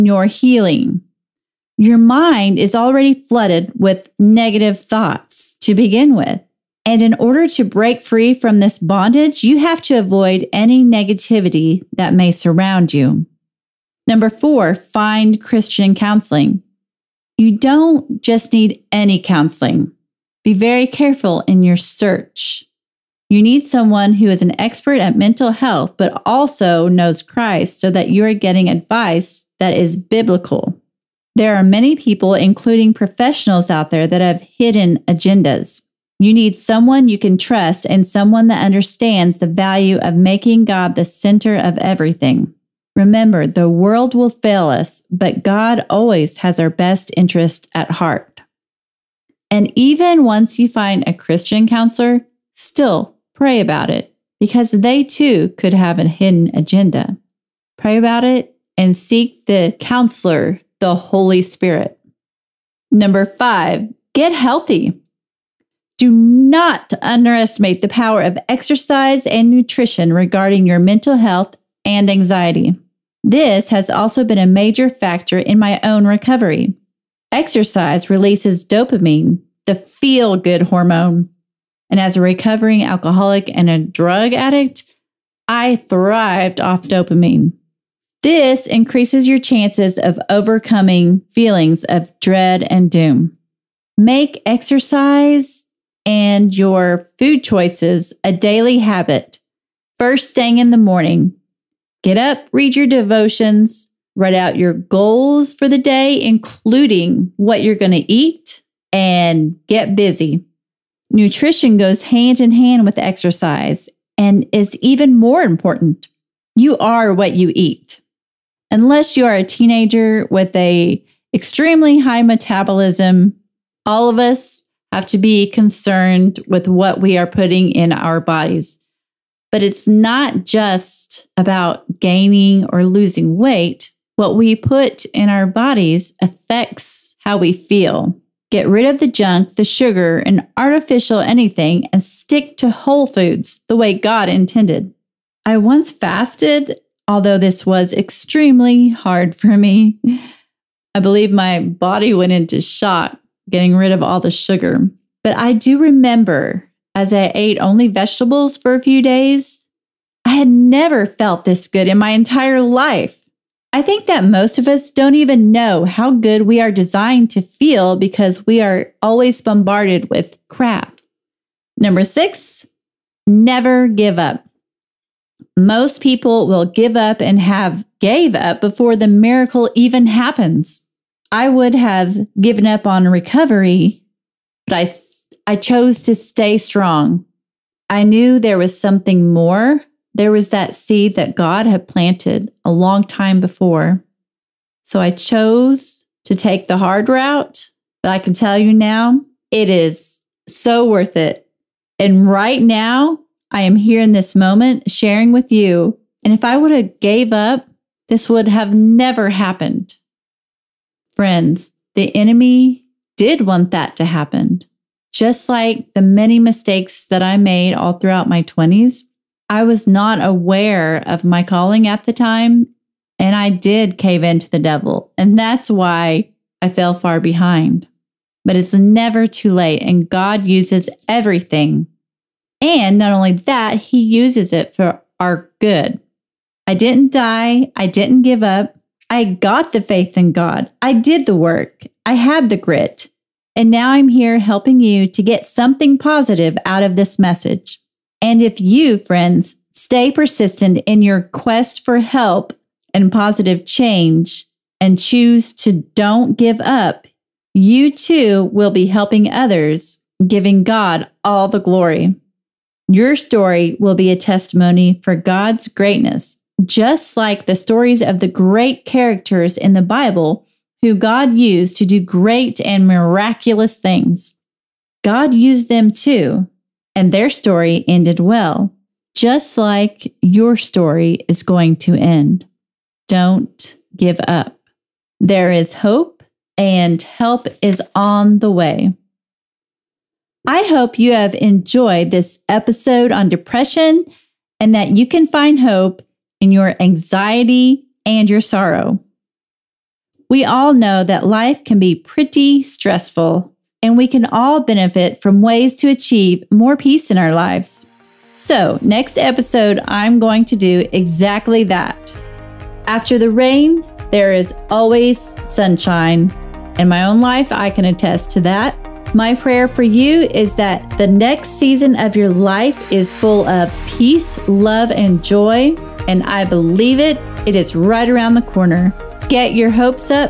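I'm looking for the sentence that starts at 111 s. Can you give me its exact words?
Nutrition goes hand in hand with exercise and is even more important.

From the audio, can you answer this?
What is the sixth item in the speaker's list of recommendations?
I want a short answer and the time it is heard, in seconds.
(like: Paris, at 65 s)
Never give up, at 173 s.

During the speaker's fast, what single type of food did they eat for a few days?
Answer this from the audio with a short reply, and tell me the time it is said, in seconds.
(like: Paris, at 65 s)
Vegetables, at 157 s.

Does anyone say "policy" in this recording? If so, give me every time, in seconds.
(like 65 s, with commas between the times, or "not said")
not said.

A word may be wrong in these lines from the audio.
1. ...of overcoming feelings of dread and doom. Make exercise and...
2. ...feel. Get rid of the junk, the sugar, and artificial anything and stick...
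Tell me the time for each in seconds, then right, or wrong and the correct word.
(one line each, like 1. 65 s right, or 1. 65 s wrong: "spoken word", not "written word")
1. 89 s right
2. 137 s right.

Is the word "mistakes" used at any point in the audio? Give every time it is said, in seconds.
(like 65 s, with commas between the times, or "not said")
216 s.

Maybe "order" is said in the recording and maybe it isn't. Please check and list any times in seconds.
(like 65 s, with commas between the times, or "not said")
7 s.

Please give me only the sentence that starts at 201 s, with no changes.
And right now, I am here in this moment sharing with you.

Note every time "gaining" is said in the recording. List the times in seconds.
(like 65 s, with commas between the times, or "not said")
131 s.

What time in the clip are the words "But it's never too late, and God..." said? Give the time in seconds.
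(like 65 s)
228 s.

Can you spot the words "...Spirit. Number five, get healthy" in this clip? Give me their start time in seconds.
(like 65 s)
61 s.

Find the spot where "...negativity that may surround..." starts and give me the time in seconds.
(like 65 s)
10 s.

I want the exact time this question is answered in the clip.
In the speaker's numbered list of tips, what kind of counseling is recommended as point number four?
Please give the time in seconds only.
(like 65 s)
15 s.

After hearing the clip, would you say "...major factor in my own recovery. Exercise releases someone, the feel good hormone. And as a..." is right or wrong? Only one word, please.
wrong.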